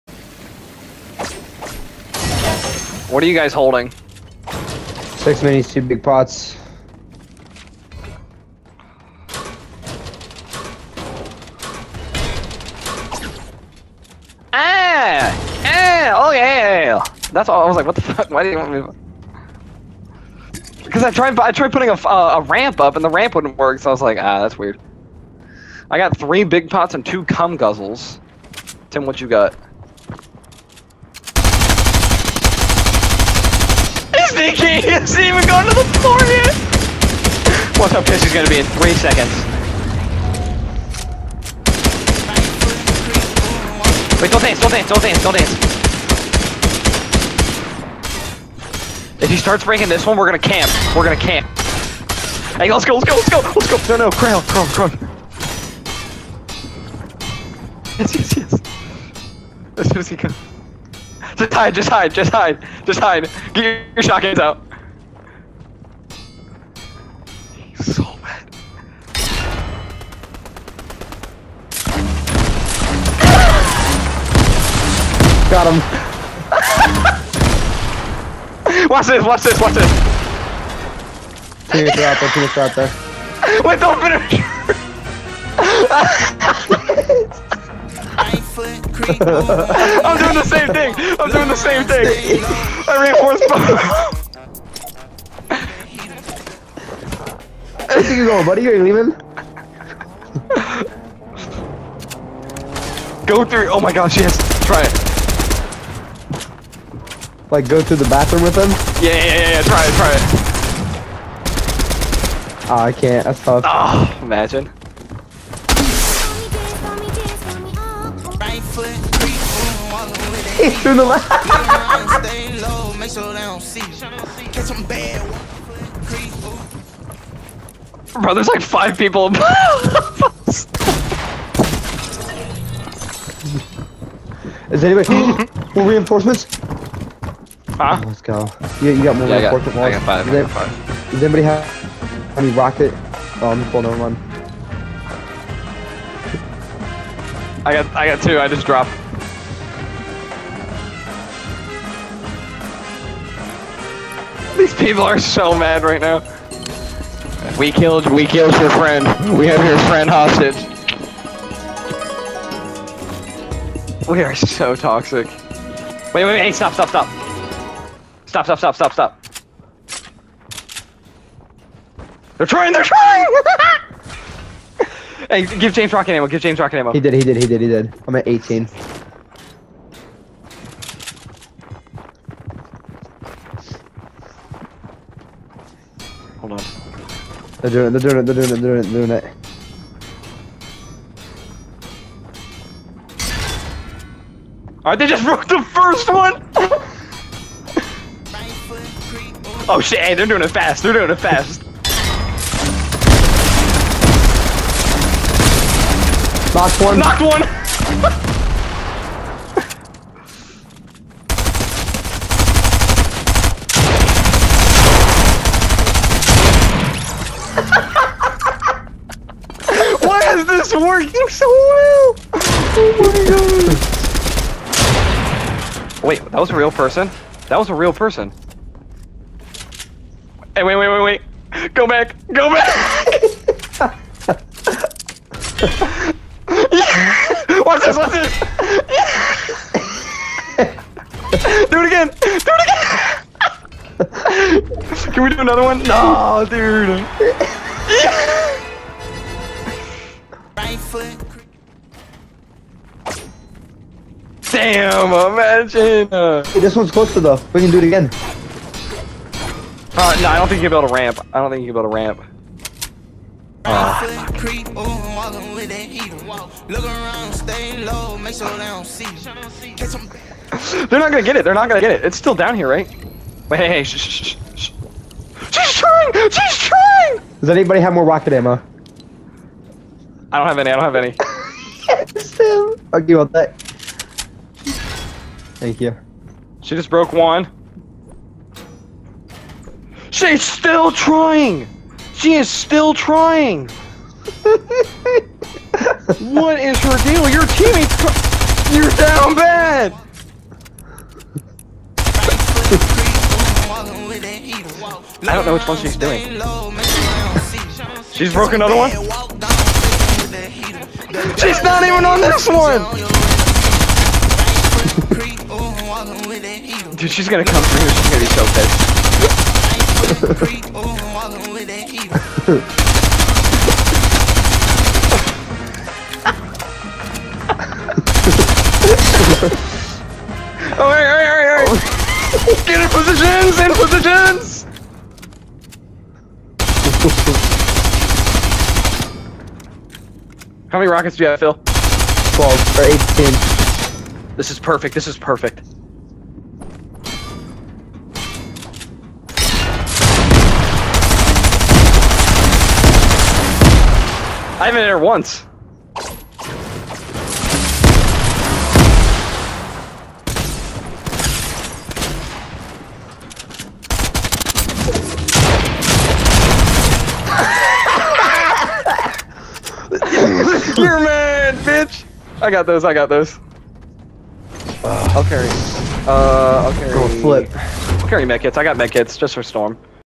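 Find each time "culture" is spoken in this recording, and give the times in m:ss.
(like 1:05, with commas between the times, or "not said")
not said.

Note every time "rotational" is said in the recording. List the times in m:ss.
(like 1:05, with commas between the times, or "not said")
not said.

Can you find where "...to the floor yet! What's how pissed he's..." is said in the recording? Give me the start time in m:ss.
0:35.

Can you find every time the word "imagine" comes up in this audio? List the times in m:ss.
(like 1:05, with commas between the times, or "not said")
1:54, 4:15.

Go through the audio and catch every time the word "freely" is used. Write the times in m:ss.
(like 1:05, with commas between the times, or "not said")
not said.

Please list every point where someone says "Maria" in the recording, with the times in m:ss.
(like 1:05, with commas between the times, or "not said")
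not said.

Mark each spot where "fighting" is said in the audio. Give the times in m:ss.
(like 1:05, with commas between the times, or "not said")
not said.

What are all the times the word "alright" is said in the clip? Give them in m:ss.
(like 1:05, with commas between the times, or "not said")
3:14, 5:31.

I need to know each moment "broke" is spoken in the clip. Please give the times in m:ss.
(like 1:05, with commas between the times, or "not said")
3:15, 4:46, 5:08.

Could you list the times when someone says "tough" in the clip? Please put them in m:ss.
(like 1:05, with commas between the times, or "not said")
1:53.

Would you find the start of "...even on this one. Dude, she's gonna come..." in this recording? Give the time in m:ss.
5:11.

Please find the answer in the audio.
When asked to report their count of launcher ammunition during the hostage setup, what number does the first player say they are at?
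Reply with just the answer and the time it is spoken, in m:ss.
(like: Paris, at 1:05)
18, at 2:58.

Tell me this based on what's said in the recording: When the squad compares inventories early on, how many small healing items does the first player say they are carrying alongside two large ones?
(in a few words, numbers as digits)
6.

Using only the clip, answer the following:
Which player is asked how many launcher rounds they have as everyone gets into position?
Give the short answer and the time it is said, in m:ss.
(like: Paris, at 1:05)
Phil, at 5:41.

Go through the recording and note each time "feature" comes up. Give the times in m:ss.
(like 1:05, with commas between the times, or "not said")
not said.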